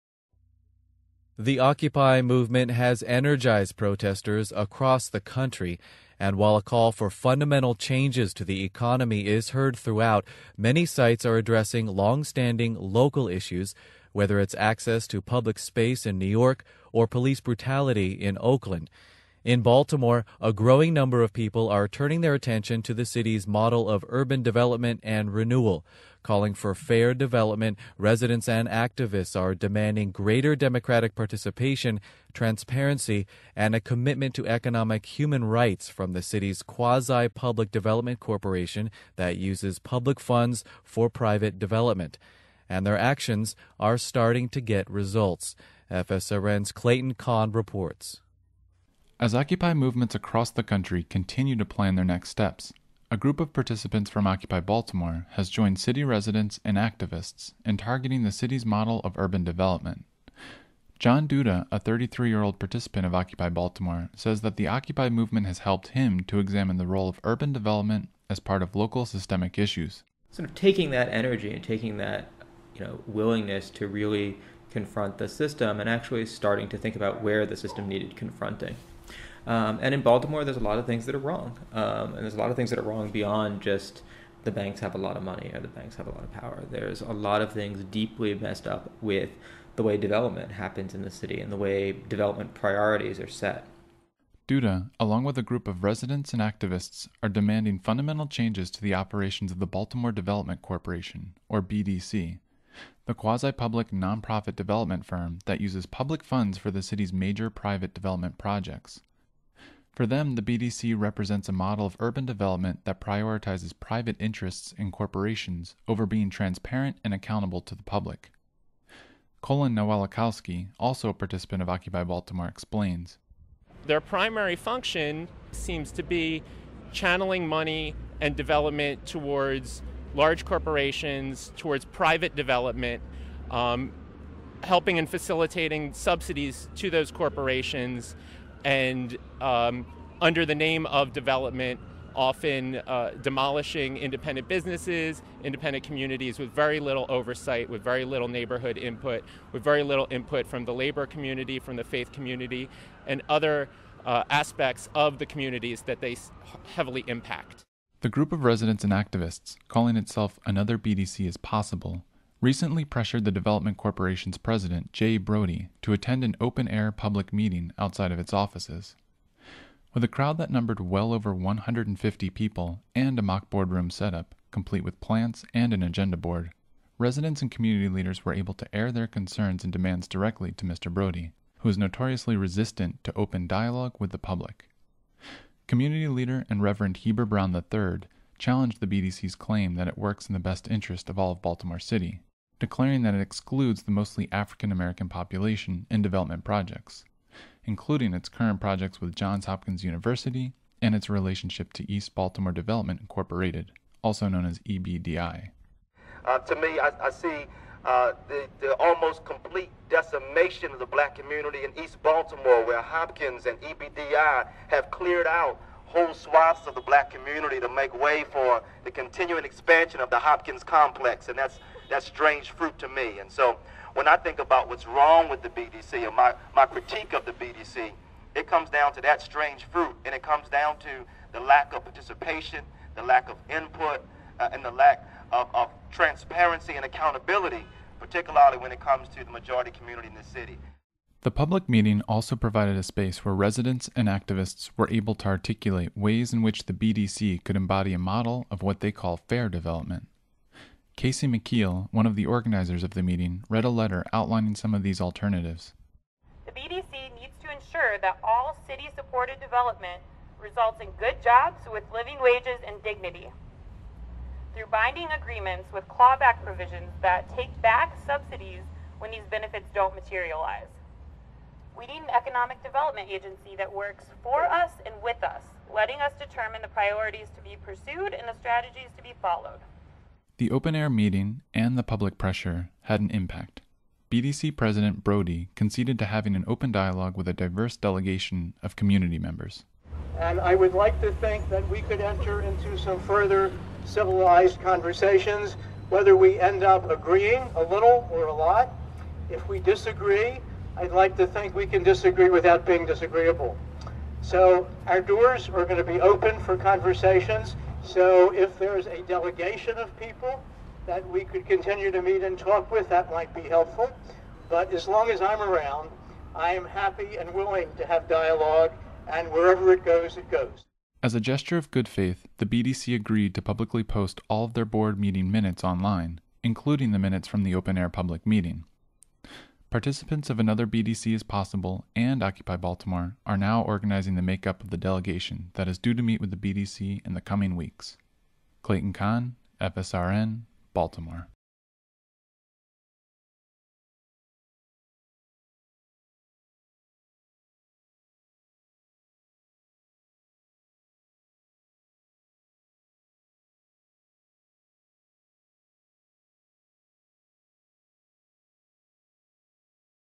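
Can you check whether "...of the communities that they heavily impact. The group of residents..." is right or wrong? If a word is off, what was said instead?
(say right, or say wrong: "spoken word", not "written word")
right.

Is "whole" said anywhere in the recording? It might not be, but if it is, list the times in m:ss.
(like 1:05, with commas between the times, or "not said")
3:35.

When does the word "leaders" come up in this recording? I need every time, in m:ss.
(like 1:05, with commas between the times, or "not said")
2:57, 3:06.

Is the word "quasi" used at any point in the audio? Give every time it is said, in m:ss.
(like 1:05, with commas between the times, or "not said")
0:36, 1:43.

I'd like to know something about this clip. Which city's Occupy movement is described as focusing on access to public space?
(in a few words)
New York.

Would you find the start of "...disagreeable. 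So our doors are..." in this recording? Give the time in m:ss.
5:02.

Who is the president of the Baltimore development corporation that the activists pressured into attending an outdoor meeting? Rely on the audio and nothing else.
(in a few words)
Jay Brodie.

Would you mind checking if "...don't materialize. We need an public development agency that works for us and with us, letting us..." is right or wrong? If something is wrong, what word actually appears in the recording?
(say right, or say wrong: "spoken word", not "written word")
wrong: "economic", not "public".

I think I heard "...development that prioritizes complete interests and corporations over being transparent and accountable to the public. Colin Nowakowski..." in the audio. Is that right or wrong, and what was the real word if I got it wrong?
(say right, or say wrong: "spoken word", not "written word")
wrong: "private", not "complete".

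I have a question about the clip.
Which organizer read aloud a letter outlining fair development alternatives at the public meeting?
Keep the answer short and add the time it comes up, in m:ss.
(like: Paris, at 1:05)
Casey McKeel, at 4:10.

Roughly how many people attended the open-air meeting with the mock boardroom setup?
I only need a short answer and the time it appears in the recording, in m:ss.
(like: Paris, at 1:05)
150, at 2:51.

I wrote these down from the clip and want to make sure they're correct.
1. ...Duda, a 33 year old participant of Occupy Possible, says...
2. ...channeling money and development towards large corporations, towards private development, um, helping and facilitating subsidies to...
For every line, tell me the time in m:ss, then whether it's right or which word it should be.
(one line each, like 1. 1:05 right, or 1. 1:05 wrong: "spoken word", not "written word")
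1. 1:01 wrong: "Baltimore", not "Possible"
2. 2:06 right.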